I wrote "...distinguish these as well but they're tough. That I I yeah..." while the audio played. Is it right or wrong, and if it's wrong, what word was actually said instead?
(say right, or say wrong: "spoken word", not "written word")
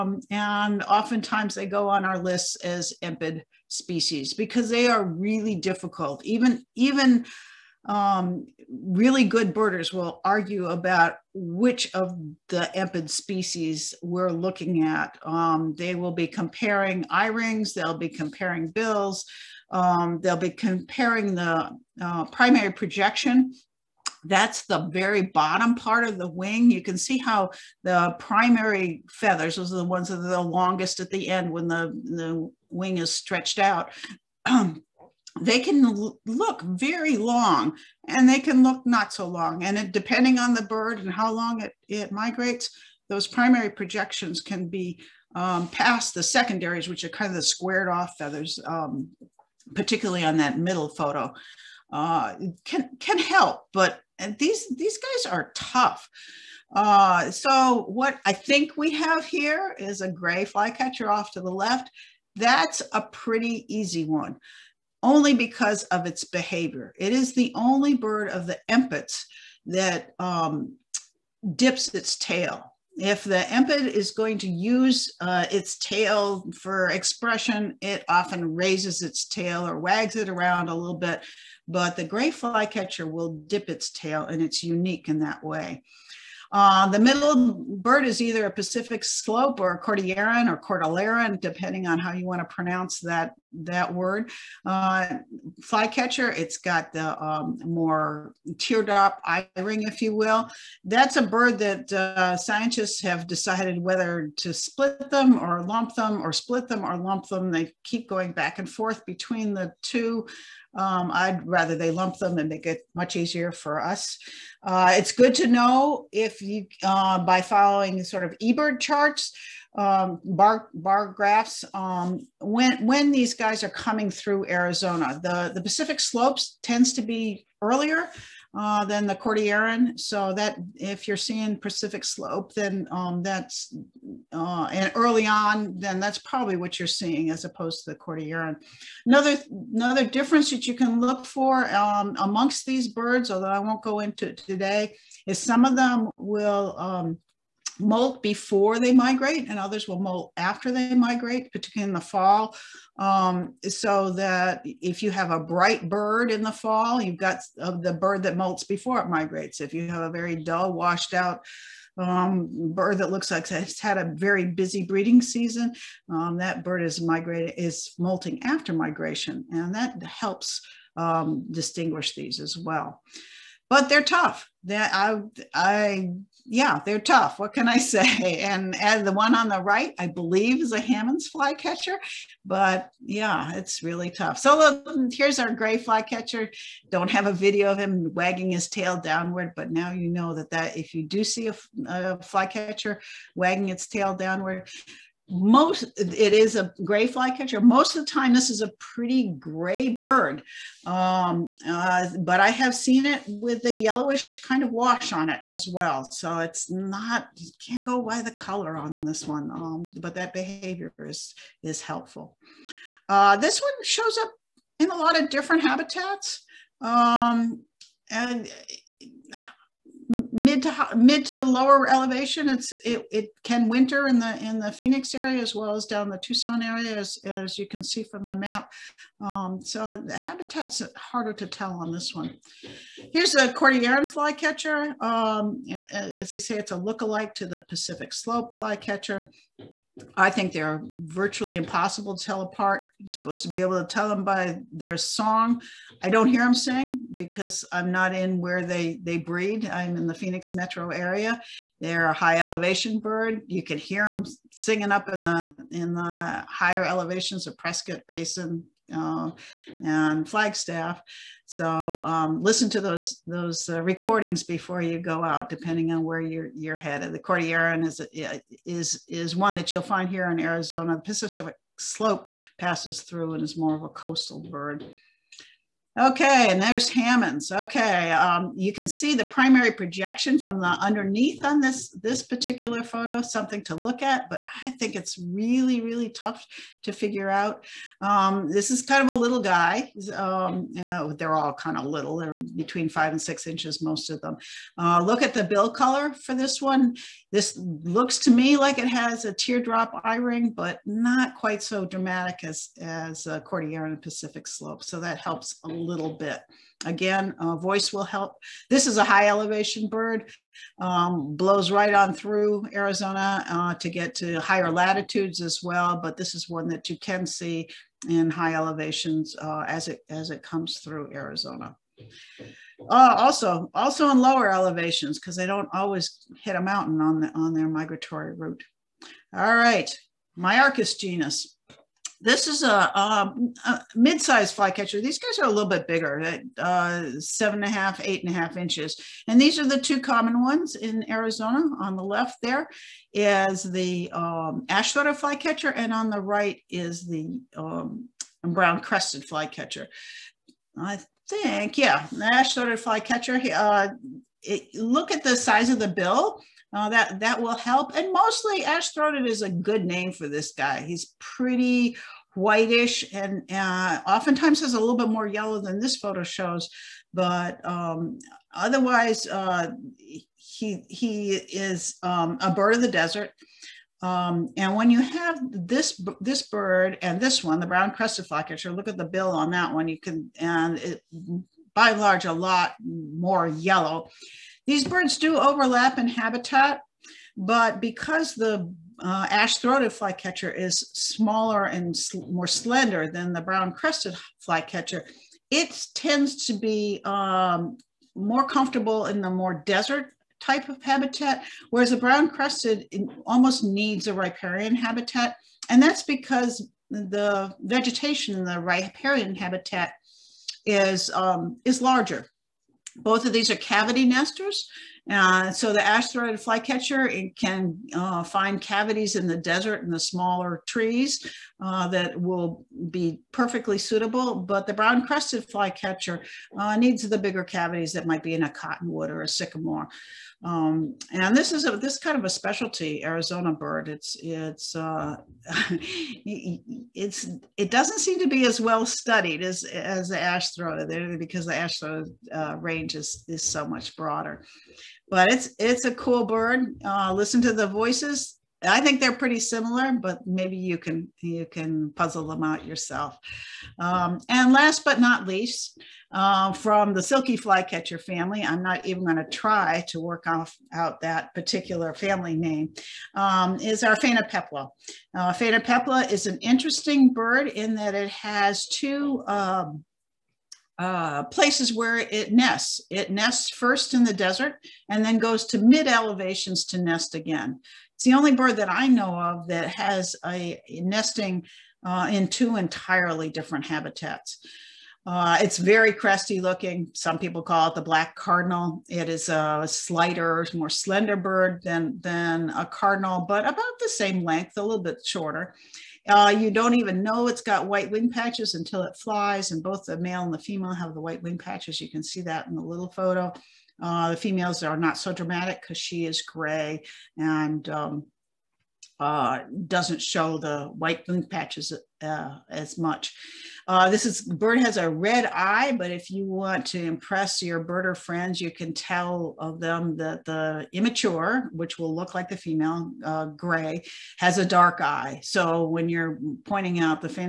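right.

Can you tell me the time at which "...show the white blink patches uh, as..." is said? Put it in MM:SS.
08:30.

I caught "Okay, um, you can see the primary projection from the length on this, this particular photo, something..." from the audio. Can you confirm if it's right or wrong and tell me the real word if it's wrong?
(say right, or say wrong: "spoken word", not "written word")
wrong: "underneath", not "length".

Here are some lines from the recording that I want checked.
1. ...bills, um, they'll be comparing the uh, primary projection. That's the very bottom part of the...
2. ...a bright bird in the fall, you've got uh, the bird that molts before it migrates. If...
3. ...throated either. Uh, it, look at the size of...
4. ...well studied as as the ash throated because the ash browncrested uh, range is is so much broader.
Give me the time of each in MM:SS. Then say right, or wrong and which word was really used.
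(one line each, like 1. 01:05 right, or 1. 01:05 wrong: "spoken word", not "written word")
1. 00:18 right
2. 02:35 right
3. 05:52 wrong: "flycatcher", not "either"
4. 07:18 wrong: "throated", not "browncrested".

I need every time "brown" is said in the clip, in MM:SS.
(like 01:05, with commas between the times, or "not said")
05:48, 06:17, 06:33, 06:41, 07:04.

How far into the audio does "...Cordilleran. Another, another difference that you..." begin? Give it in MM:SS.
02:17.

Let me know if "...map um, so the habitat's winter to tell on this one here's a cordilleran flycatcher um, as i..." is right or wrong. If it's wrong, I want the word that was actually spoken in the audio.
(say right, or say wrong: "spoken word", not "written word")
wrong: "harder", not "winter".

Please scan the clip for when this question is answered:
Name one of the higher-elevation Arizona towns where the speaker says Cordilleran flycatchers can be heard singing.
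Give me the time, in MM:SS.
04:17.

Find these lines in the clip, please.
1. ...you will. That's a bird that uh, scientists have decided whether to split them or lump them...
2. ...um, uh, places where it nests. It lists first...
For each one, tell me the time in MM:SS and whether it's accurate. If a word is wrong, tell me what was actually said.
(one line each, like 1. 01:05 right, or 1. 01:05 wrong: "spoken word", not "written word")
1. 01:40 right
2. 07:49 wrong: "nests", not "lists".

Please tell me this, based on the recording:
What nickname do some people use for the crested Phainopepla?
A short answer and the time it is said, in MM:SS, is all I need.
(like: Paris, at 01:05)
black cardinal, at 08:07.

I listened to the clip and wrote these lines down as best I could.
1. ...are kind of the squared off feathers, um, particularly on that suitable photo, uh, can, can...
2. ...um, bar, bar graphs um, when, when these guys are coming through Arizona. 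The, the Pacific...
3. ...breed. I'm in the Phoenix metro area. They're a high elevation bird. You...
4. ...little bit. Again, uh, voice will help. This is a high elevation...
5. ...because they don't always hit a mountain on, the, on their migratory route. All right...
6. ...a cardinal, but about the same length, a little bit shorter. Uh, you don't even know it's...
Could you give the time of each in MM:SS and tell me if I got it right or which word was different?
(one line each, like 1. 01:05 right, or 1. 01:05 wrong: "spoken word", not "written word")
1. 00:47 wrong: "middle", not "suitable"
2. 01:59 right
3. 04:09 right
4. 05:05 right
5. 05:25 right
6. 08:12 right.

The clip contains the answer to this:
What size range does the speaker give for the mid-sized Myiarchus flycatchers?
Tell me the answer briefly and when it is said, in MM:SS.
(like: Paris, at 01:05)
7.5 to 8.5 inches, at 05:37.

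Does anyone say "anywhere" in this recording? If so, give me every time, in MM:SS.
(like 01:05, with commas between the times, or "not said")
not said.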